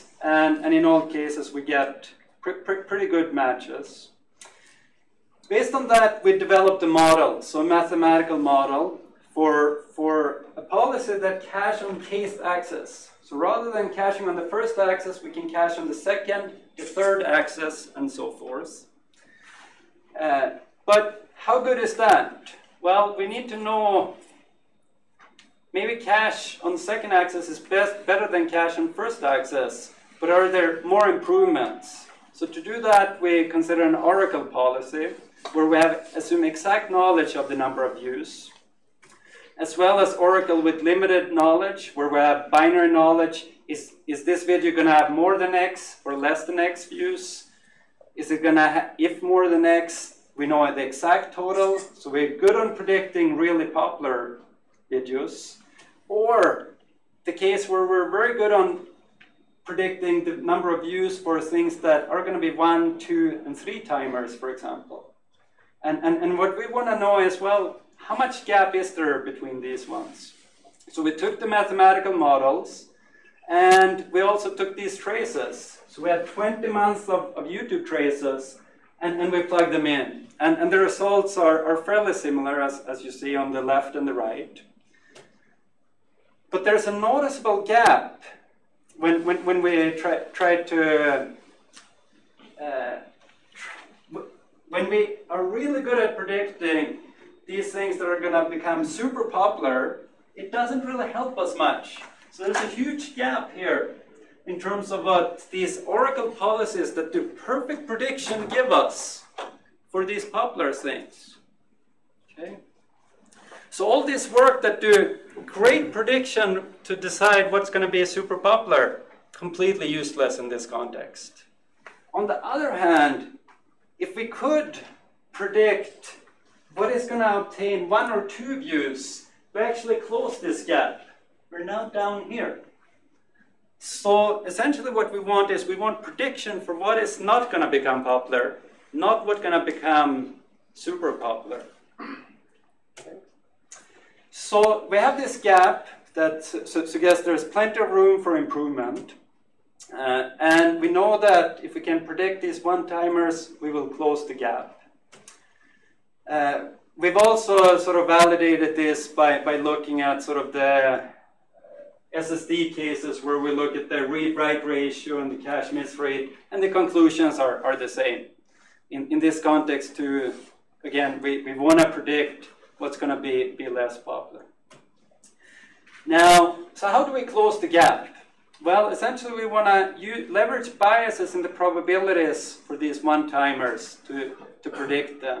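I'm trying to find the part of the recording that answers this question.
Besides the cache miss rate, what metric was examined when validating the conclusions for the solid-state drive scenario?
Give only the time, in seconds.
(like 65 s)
164 s.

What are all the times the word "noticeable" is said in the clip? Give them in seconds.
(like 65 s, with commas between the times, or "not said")
86 s.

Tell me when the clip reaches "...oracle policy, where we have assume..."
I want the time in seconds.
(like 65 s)
33 s.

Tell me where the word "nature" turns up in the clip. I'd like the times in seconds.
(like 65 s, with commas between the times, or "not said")
not said.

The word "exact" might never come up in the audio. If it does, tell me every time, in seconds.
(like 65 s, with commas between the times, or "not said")
36 s, 50 s.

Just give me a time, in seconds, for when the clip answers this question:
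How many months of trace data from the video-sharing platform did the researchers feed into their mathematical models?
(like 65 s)
76 s.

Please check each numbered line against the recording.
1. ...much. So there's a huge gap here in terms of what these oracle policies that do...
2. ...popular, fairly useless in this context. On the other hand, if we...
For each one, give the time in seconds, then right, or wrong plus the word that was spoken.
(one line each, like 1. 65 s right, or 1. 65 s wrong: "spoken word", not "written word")
1. 101 s right
2. 118 s wrong: "completely", not "fairly".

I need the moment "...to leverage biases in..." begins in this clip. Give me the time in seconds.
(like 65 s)
179 s.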